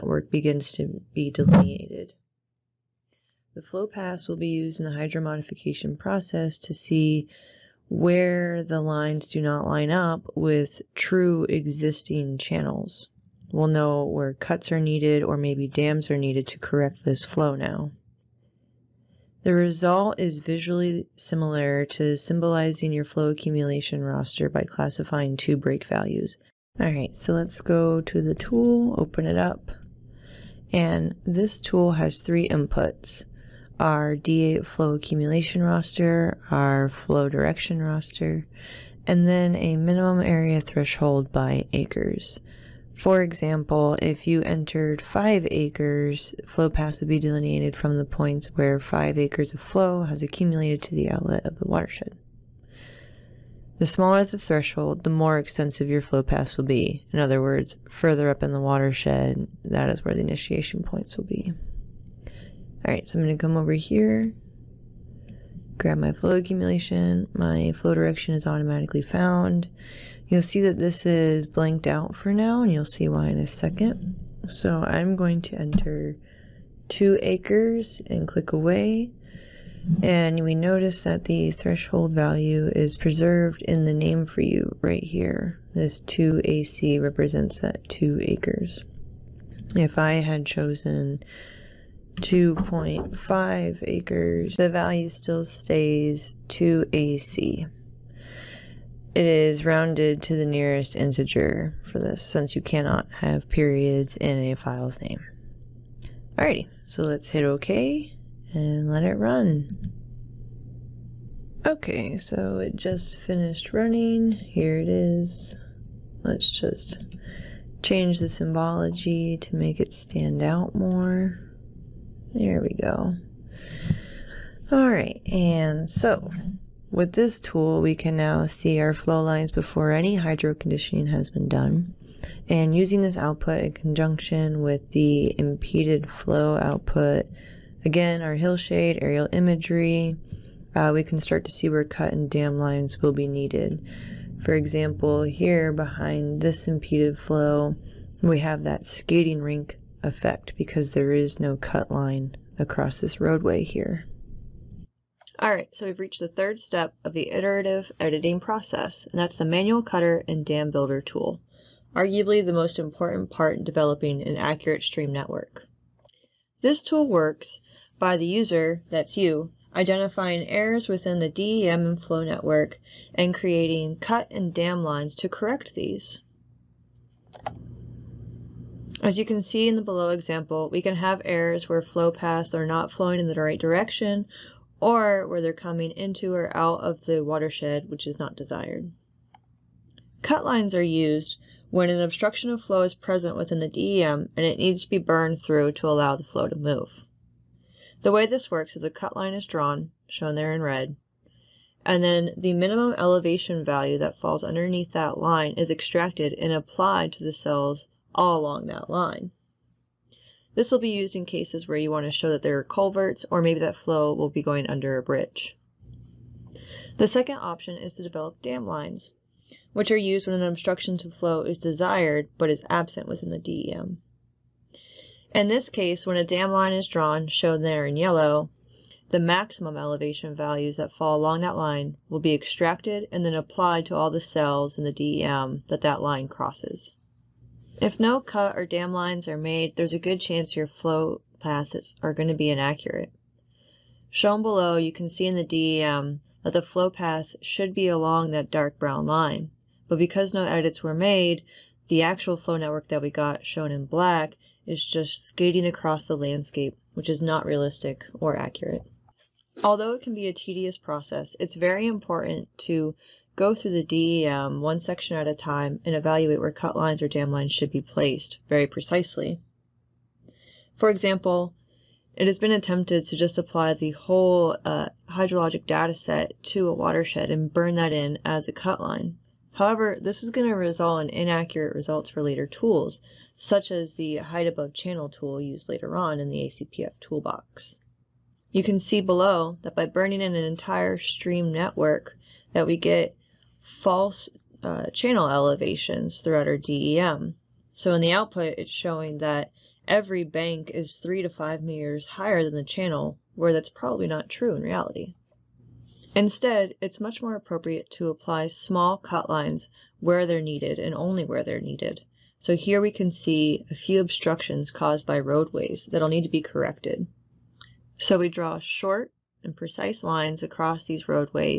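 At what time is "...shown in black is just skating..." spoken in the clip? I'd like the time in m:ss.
4:13.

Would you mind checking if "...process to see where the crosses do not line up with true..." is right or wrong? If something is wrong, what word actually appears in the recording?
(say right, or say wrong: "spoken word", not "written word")
wrong: "lines", not "crosses".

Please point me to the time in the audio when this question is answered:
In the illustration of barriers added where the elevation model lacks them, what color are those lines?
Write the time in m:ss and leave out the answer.
3:47.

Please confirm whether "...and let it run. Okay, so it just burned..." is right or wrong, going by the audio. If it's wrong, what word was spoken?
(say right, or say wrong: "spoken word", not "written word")
wrong: "finished", not "burned".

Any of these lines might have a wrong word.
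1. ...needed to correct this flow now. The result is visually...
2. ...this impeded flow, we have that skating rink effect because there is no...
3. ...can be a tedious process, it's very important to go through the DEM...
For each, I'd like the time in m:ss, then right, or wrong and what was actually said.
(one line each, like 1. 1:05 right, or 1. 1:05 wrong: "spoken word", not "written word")
1. 0:16 right
2. 2:26 right
3. 4:20 right.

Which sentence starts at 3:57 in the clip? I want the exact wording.
If no cut or dam lines are made, there's a good chance your flow paths are going to be inaccurate.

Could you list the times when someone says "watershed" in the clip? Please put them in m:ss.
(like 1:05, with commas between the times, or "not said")
0:51, 0:58, 3:07, 4:36.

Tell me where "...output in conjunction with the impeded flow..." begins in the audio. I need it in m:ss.
2:13.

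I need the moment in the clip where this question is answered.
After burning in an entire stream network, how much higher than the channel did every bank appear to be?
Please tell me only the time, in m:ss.
5:00.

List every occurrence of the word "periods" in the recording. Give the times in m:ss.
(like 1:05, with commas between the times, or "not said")
1:43.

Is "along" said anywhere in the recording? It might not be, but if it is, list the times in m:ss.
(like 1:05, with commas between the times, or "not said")
3:28, 3:51, 4:07.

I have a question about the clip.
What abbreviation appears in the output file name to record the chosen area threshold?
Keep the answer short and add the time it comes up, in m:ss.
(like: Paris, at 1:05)
2AC, at 1:25.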